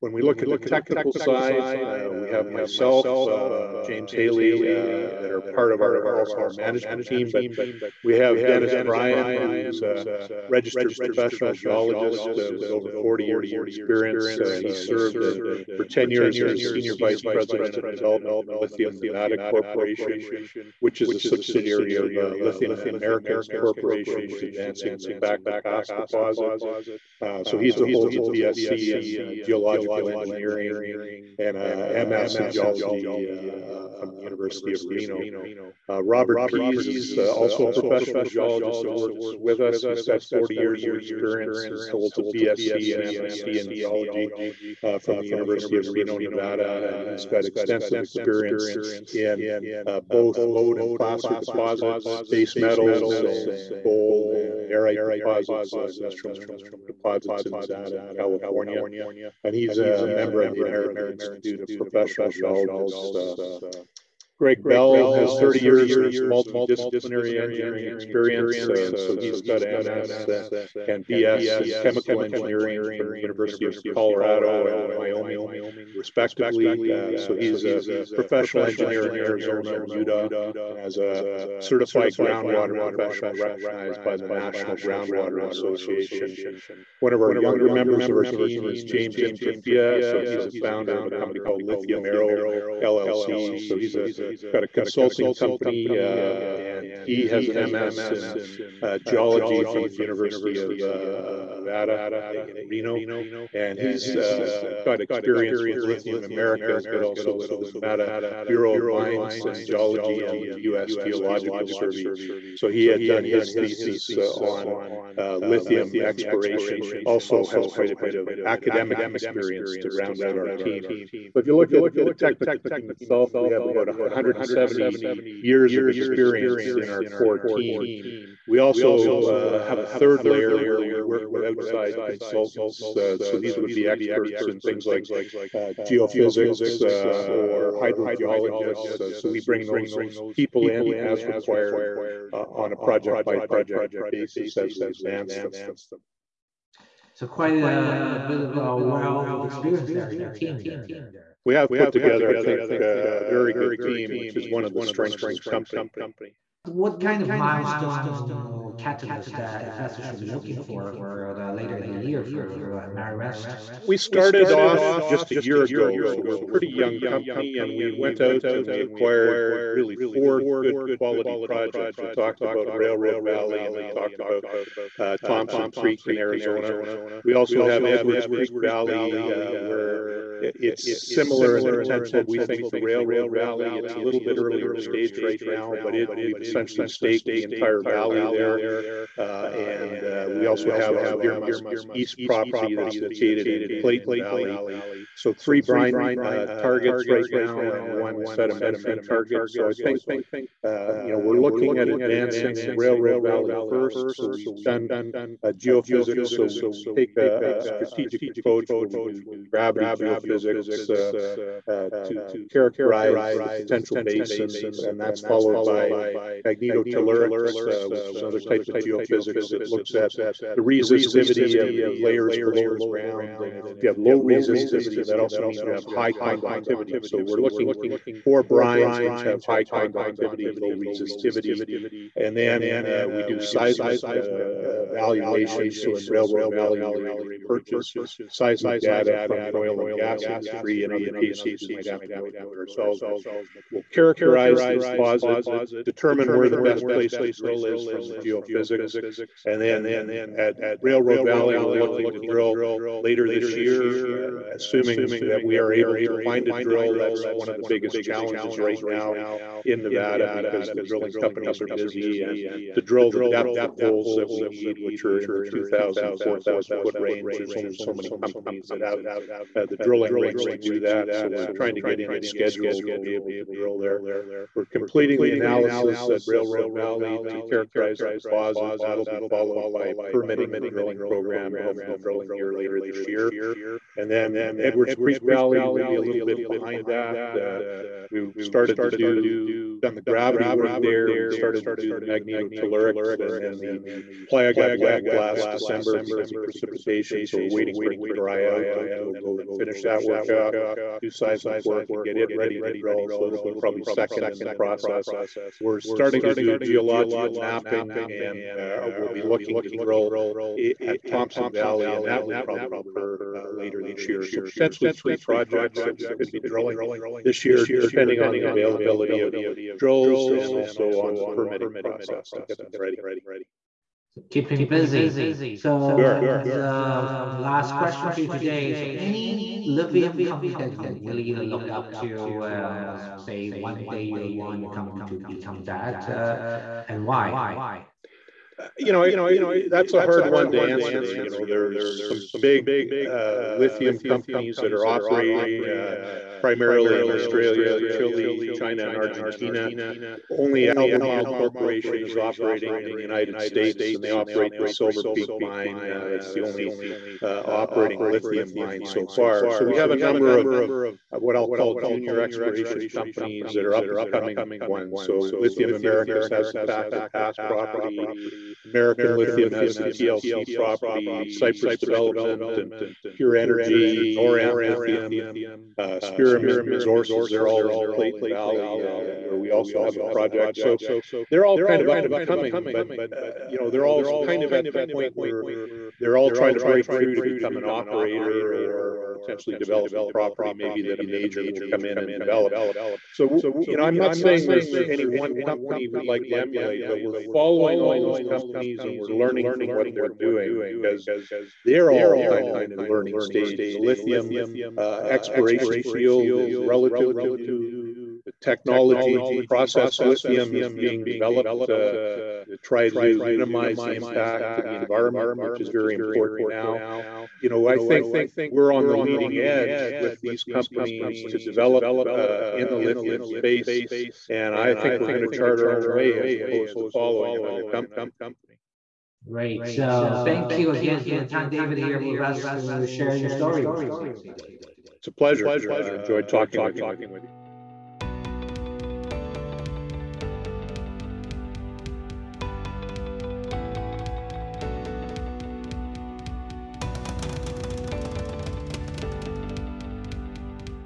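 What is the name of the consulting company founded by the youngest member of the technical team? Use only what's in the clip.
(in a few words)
Lithium Arrow LLC.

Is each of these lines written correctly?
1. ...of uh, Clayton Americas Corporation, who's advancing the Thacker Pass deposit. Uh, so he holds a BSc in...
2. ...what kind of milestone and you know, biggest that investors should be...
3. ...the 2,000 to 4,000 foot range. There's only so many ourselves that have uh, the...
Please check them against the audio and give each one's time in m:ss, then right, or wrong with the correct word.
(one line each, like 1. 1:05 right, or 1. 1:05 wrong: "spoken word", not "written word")
1. 0:21 wrong: "Lithium", not "Clayton"
2. 2:36 wrong: "catalyst", not "biggest"
3. 4:25 wrong: "companies", not "ourselves".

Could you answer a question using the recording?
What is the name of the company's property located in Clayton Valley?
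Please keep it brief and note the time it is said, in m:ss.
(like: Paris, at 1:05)
Deer Musk East, at 3:11.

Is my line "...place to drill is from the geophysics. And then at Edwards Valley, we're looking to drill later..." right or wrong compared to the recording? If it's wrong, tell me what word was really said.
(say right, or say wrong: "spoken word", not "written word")
wrong: "Railroad", not "Edwards".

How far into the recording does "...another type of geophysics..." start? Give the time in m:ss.
3:38.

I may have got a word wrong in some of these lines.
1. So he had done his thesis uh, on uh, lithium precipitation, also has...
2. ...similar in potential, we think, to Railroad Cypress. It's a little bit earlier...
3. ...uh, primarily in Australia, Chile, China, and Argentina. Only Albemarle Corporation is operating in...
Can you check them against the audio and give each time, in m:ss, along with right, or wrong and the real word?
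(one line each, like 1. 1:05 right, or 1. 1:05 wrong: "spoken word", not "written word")
1. 1:52 wrong: "exploration", not "precipitation"
2. 3:01 wrong: "Valley", not "Cypress"
3. 5:45 right.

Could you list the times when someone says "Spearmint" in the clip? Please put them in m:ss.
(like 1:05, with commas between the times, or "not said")
6:16.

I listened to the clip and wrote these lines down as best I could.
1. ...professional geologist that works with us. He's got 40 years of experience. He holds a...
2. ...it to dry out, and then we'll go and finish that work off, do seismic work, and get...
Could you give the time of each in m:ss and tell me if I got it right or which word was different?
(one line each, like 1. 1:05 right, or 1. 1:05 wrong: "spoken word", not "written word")
1. 0:37 right
2. 4:57 right.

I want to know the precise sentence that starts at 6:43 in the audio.
The lithium uh, exploration field is relatively new.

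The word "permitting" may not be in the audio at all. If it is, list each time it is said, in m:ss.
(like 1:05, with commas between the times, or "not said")
4:40, 5:21.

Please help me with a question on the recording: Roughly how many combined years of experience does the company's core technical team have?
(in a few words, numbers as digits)
170.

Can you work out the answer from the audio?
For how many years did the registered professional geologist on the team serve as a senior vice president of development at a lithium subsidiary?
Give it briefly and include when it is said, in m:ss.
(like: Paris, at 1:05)
10, at 0:15.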